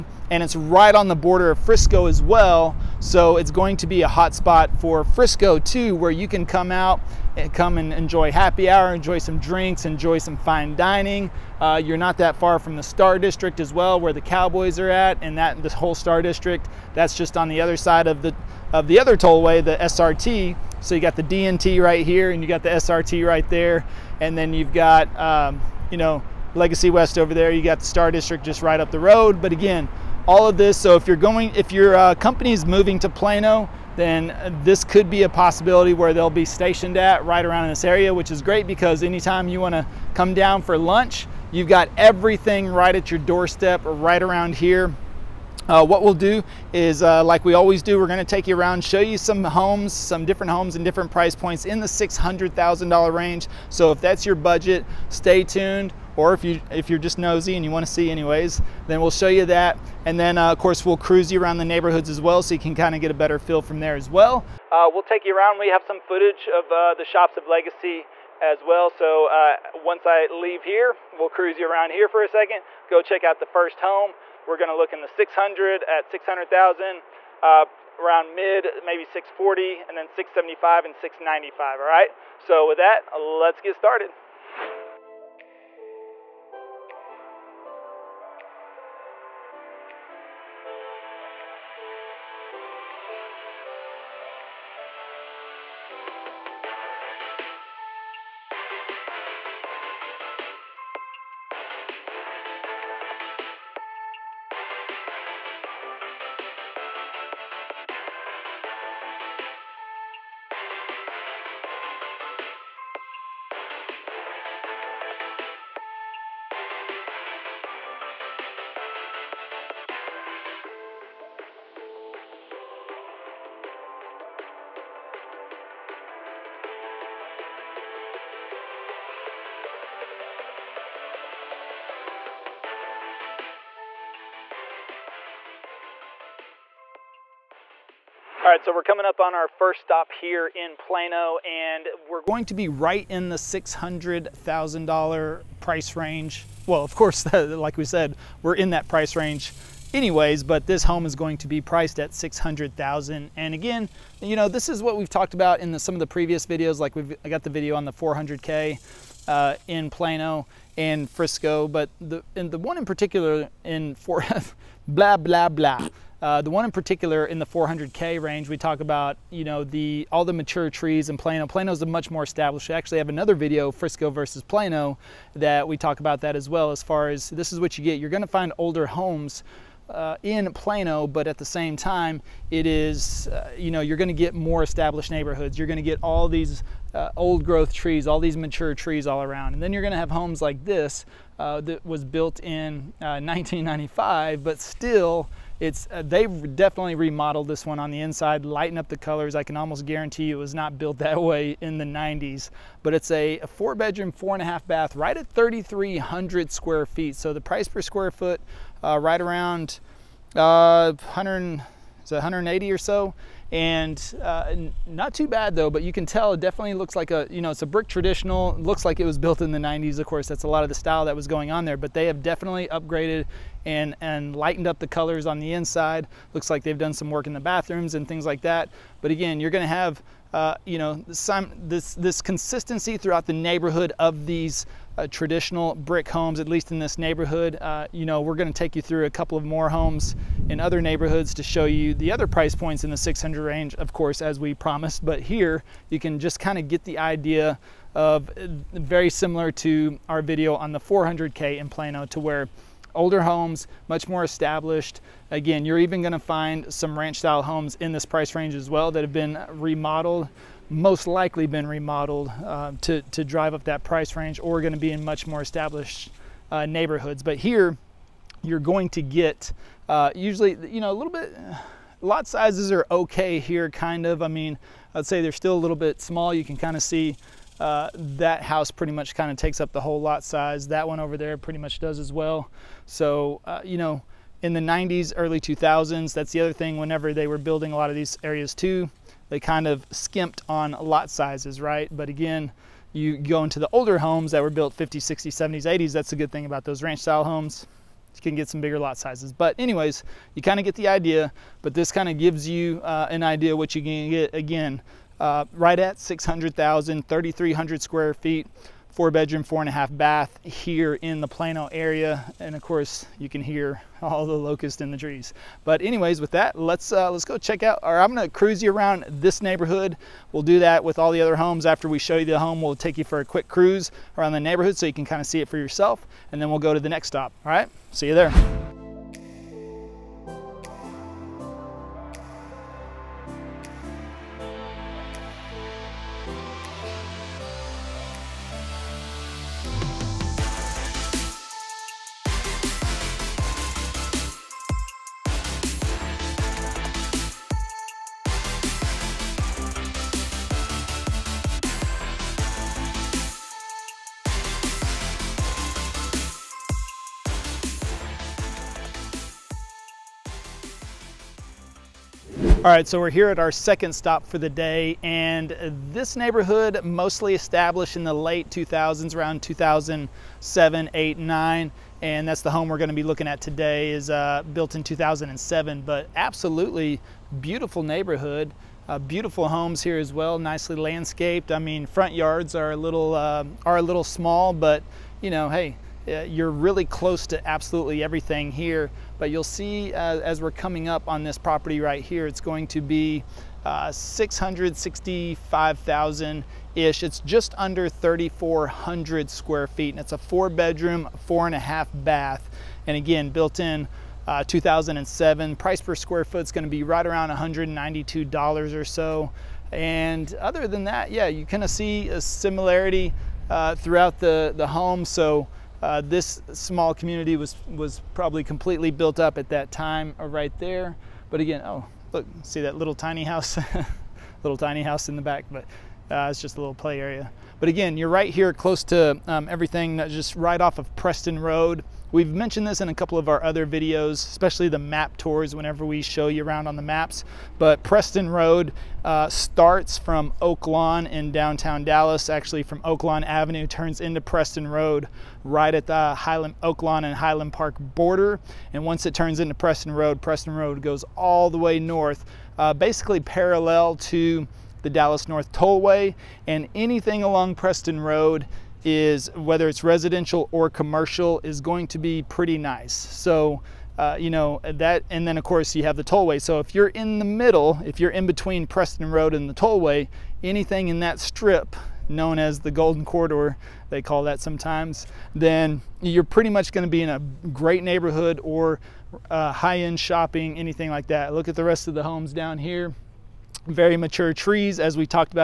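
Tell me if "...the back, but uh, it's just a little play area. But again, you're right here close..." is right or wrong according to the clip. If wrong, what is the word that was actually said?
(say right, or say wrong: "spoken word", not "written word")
right.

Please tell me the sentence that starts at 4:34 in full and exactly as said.
I mean, I'd say they're still a little bit small.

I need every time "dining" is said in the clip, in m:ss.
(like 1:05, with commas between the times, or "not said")
0:10.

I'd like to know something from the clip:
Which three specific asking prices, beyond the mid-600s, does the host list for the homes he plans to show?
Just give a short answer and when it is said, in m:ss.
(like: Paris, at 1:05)
640, 675 and 695, at 1:19.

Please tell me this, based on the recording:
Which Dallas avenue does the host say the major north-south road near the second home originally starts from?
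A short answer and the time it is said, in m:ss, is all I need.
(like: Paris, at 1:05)
Oak Lawn Avenue, at 7:22.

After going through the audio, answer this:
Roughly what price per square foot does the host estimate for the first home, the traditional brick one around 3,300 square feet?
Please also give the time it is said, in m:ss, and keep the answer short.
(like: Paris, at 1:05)
About $180, at 3:32.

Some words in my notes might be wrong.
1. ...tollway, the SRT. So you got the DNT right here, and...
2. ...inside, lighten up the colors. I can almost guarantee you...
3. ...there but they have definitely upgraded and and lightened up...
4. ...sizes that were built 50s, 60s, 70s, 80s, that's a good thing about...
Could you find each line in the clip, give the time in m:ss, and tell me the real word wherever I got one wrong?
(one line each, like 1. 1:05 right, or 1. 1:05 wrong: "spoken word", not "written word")
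1. 0:19 right
2. 3:18 right
3. 3:41 right
4. 4:53 wrong: "homes", not "sizes".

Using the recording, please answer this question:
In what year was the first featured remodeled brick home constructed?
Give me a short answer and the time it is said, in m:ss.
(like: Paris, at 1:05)
1995, at 3:12.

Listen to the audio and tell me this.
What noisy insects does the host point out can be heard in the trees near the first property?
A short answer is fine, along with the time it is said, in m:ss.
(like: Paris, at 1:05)
Locusts, at 5:14.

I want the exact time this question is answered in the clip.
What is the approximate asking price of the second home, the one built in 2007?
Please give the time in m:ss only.
6:33.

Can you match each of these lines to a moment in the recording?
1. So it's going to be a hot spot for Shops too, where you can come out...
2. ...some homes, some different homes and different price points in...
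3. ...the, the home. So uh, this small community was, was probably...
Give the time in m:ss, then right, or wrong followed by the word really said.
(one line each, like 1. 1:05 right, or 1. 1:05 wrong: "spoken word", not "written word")
1. 0:02 wrong: "Frisco", not "Shops"
2. 0:49 right
3. 6:54 right.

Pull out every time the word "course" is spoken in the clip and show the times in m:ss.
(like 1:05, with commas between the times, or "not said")
1:00, 2:26, 3:40, 4:03, 5:12, 7:45.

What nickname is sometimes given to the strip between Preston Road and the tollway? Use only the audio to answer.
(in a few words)
The golden corridor.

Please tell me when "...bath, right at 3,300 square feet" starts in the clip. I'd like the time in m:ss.
3:24.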